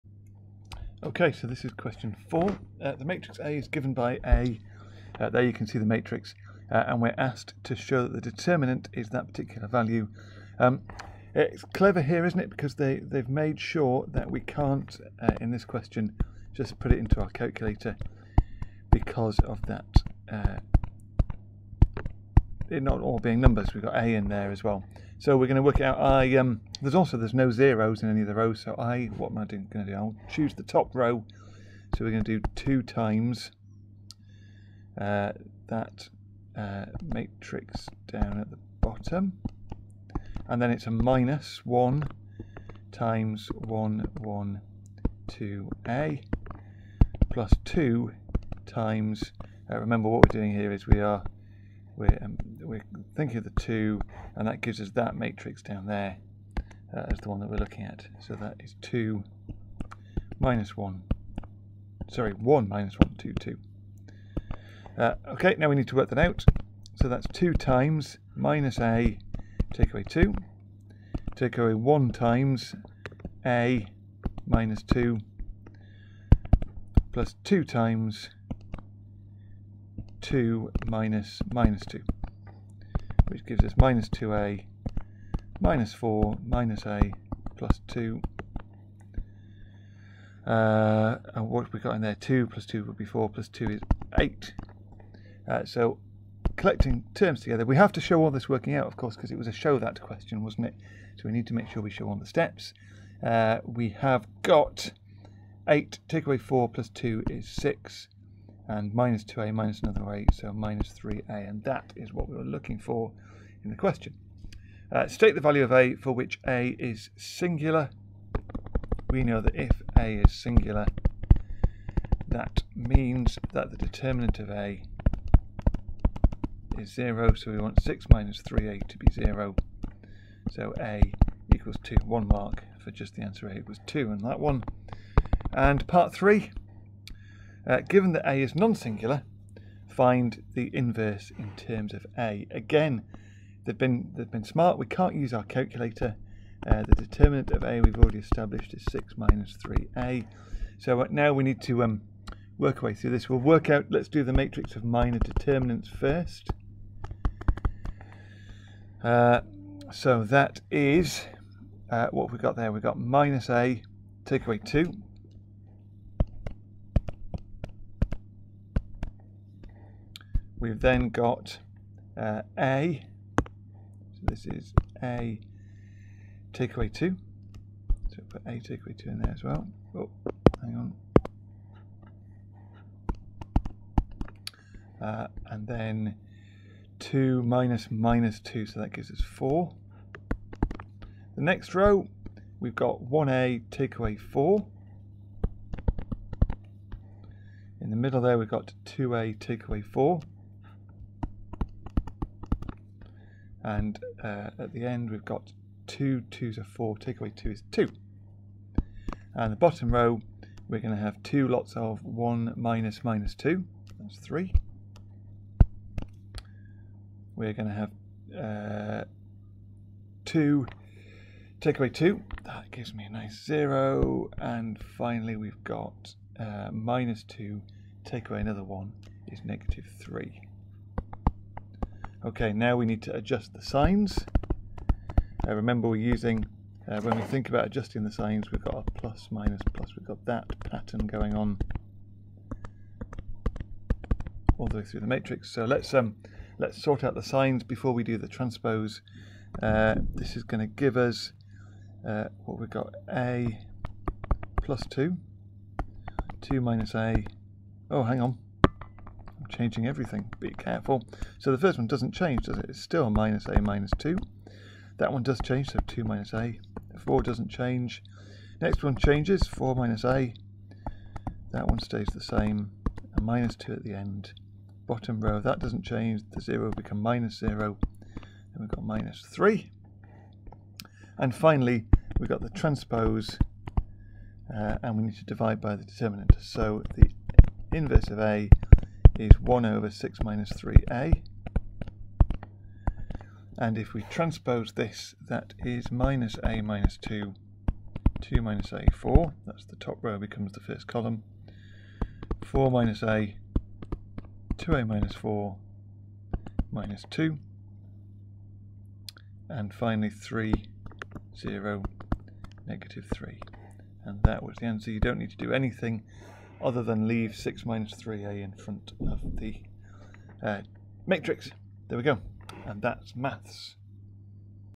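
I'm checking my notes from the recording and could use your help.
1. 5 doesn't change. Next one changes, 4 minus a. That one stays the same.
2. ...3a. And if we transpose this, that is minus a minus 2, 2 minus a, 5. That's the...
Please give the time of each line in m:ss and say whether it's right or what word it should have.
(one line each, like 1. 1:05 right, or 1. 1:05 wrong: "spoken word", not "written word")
1. 4:26 wrong: "4", not "5"
2. 4:50 wrong: "4", not "5".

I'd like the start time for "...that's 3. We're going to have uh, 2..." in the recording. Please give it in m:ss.
3:33.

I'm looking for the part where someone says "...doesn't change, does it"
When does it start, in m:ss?
4:21.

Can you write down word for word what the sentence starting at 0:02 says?
Uh, the matrix A is given by A.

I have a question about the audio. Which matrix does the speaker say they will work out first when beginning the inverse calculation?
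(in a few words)
matrix of minor determinants.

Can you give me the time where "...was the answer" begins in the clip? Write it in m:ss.
5:14.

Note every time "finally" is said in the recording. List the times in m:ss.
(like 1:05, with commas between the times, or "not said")
3:44, 4:41, 5:09.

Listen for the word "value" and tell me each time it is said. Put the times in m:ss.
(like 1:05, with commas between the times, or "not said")
0:09, 1:55.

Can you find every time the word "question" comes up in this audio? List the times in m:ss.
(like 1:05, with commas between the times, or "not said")
0:01, 0:15, 1:40, 1:53.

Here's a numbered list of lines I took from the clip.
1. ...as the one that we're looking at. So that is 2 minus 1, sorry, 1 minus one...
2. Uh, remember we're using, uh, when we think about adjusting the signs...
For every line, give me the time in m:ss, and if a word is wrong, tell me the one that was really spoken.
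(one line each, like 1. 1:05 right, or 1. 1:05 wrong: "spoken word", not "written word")
1. 0:57 right
2. 3:55 right.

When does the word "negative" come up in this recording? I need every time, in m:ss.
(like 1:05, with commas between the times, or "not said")
3:49, 5:12.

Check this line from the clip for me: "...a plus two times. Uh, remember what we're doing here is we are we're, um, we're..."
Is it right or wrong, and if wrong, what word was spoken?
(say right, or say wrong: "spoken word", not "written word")
right.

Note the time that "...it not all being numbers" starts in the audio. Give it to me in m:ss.
0:22.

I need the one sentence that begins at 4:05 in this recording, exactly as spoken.
So let's, um, let's sort out the signs before we do the transpose.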